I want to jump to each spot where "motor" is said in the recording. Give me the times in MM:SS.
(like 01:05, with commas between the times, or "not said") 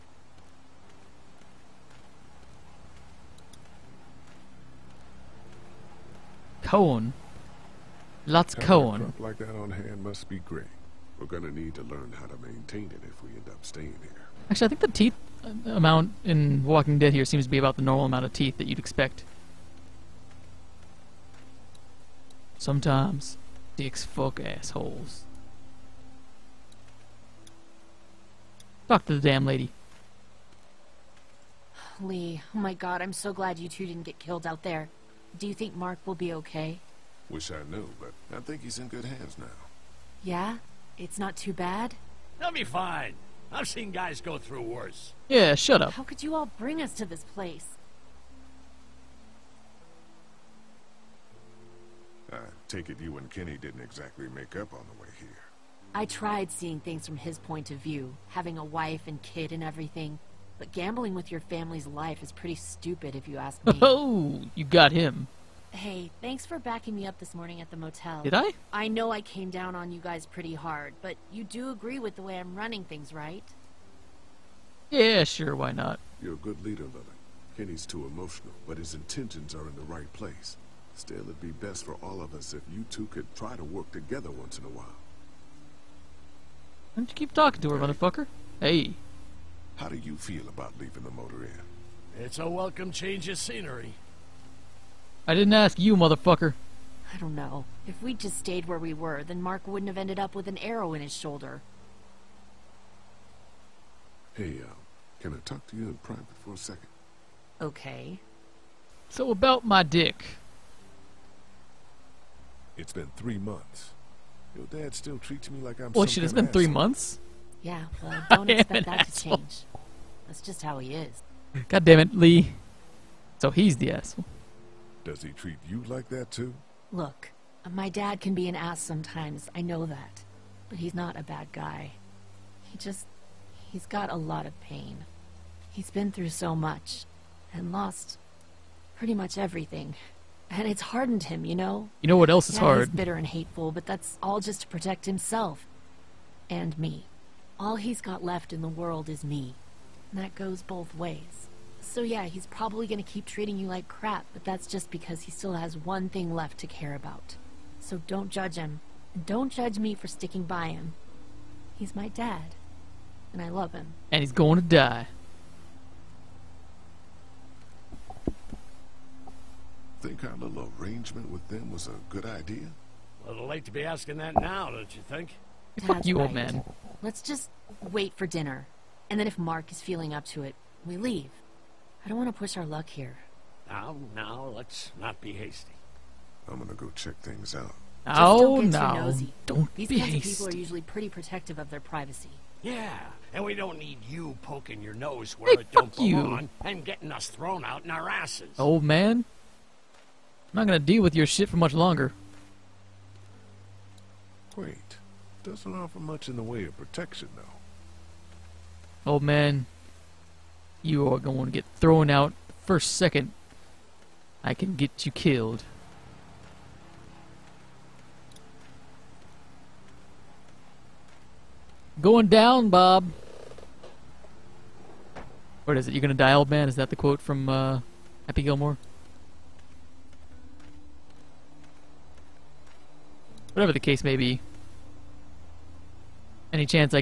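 01:31.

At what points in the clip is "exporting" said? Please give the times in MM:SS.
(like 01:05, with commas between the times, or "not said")
not said.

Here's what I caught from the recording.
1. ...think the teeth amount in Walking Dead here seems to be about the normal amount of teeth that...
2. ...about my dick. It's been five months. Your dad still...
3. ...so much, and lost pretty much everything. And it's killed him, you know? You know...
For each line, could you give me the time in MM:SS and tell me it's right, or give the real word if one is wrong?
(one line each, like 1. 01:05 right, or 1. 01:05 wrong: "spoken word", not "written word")
1. 00:14 right
2. 01:49 wrong: "three", not "five"
3. 02:16 wrong: "hardened", not "killed".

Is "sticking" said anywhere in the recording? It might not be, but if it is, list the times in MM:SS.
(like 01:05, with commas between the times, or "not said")
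02:40.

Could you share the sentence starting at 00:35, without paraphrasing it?
Do you think Mark will be okay?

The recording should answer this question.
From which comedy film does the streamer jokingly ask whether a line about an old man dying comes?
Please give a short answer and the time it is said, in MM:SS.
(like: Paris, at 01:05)
Happy Gilmore, at 03:48.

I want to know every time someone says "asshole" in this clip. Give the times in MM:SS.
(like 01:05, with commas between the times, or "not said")
00:24, 01:58, 02:03.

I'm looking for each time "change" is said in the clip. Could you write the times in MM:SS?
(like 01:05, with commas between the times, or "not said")
01:32, 01:59.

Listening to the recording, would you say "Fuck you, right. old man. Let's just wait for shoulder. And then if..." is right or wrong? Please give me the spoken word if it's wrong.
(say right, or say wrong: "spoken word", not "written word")
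wrong: "dinner", not "shoulder".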